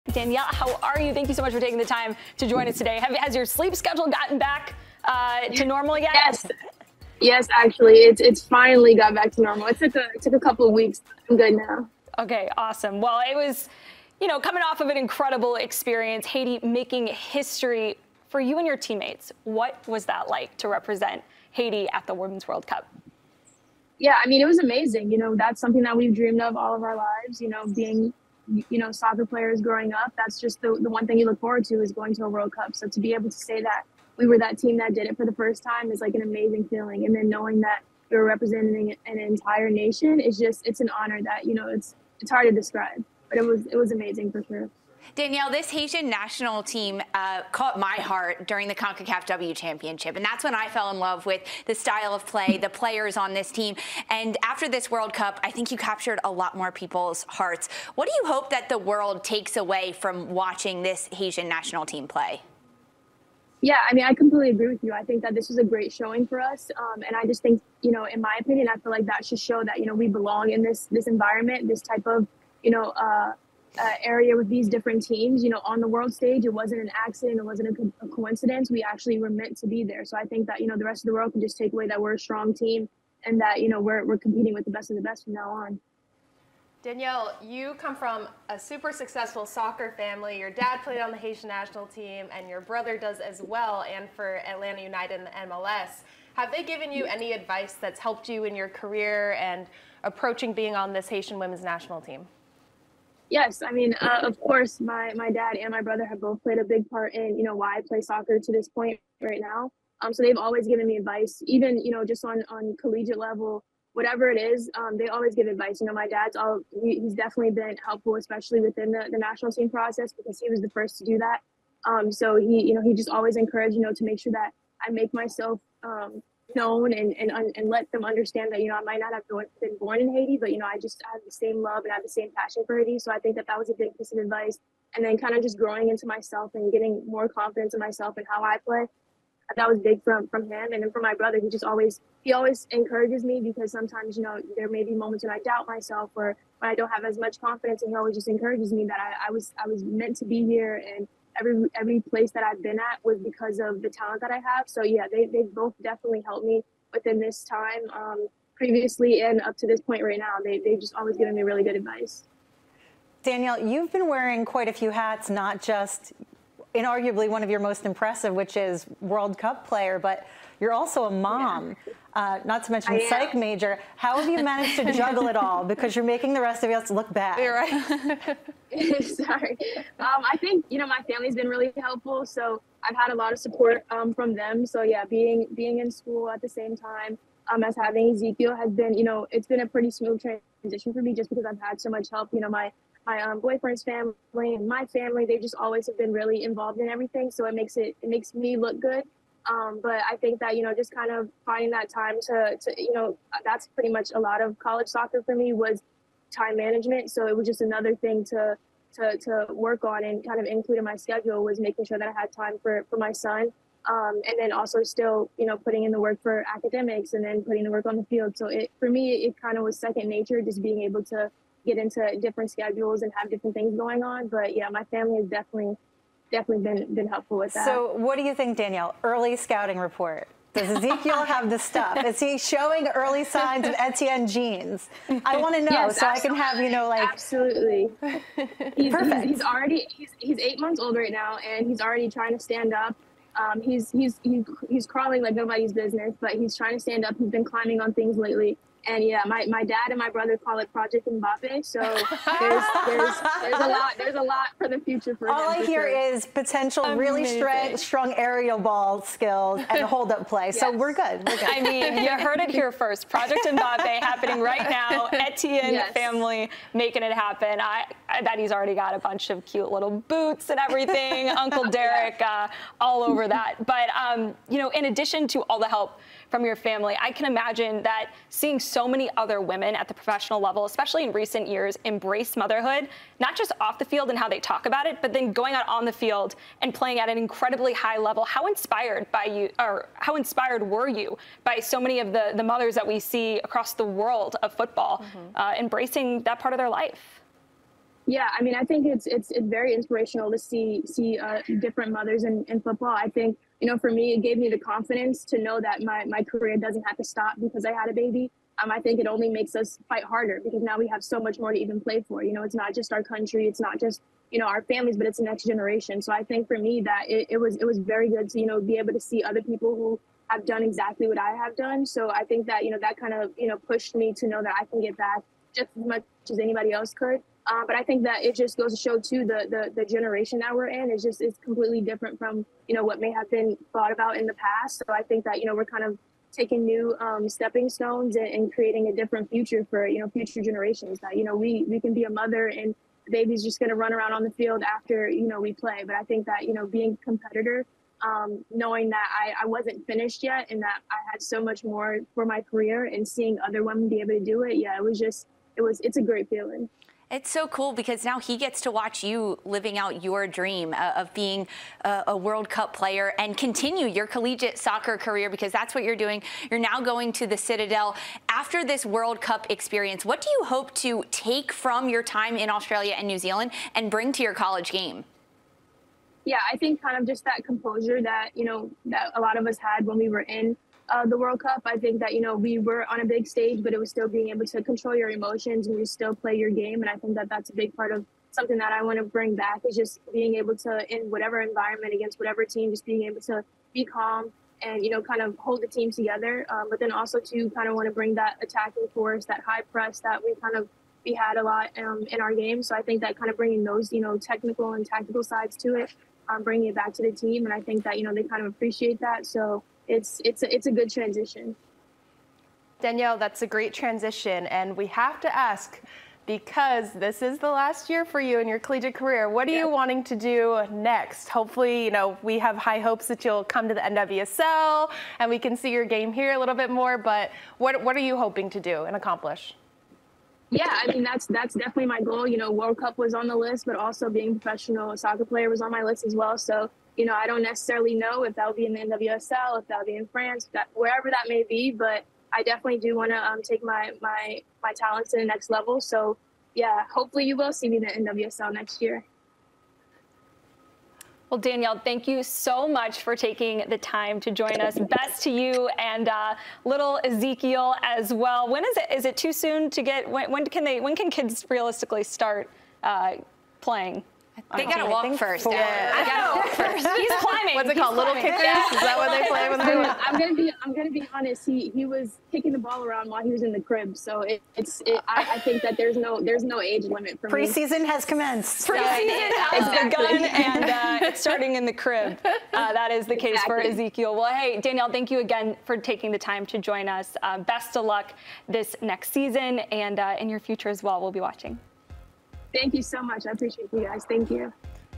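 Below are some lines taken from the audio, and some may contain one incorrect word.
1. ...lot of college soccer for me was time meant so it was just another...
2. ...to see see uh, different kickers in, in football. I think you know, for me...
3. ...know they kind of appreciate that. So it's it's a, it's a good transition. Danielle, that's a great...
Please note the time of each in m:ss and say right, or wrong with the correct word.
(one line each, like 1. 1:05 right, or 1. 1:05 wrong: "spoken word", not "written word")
1. 3:24 wrong: "management", not "meant"
2. 5:00 wrong: "mothers", not "kickers"
3. 6:48 right.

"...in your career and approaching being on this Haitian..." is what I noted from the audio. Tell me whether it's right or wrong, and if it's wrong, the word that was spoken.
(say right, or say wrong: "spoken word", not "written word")
right.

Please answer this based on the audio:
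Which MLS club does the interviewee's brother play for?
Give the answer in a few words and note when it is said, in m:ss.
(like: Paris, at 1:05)
Atlanta United, at 1:34.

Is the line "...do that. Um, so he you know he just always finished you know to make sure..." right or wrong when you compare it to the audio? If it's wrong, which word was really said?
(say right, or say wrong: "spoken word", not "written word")
wrong: "encouraged", not "finished".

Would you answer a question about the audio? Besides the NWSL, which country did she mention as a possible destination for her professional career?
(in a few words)
France.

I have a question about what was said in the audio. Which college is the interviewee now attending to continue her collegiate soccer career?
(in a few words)
The Citadel.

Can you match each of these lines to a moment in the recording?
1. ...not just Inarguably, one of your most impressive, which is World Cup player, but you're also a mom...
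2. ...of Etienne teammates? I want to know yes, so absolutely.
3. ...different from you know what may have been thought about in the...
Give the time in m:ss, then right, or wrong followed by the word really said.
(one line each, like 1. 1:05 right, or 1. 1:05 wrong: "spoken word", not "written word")
1. 2:45 right
2. 3:53 wrong: "genes", not "teammates"
3. 5:31 right.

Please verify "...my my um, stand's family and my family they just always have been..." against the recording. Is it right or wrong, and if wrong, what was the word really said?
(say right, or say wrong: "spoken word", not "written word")
wrong: "boyfriend", not "stand".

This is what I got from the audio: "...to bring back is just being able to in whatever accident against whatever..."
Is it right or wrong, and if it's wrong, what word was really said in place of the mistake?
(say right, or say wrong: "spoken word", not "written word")
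wrong: "environment", not "accident".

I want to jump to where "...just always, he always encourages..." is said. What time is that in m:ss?
2:21.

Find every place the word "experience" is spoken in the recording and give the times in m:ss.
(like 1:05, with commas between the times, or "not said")
0:15, 6:09.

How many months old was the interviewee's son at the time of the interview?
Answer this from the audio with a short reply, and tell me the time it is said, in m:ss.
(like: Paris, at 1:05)
8, at 4:00.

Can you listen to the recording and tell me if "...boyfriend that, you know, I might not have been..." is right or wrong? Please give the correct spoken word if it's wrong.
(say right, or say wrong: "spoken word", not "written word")
wrong: "understand", not "boyfriend".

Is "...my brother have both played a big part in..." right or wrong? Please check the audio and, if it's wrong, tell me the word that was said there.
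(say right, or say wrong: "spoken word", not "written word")
right.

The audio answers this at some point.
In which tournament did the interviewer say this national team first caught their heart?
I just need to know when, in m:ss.
0:48.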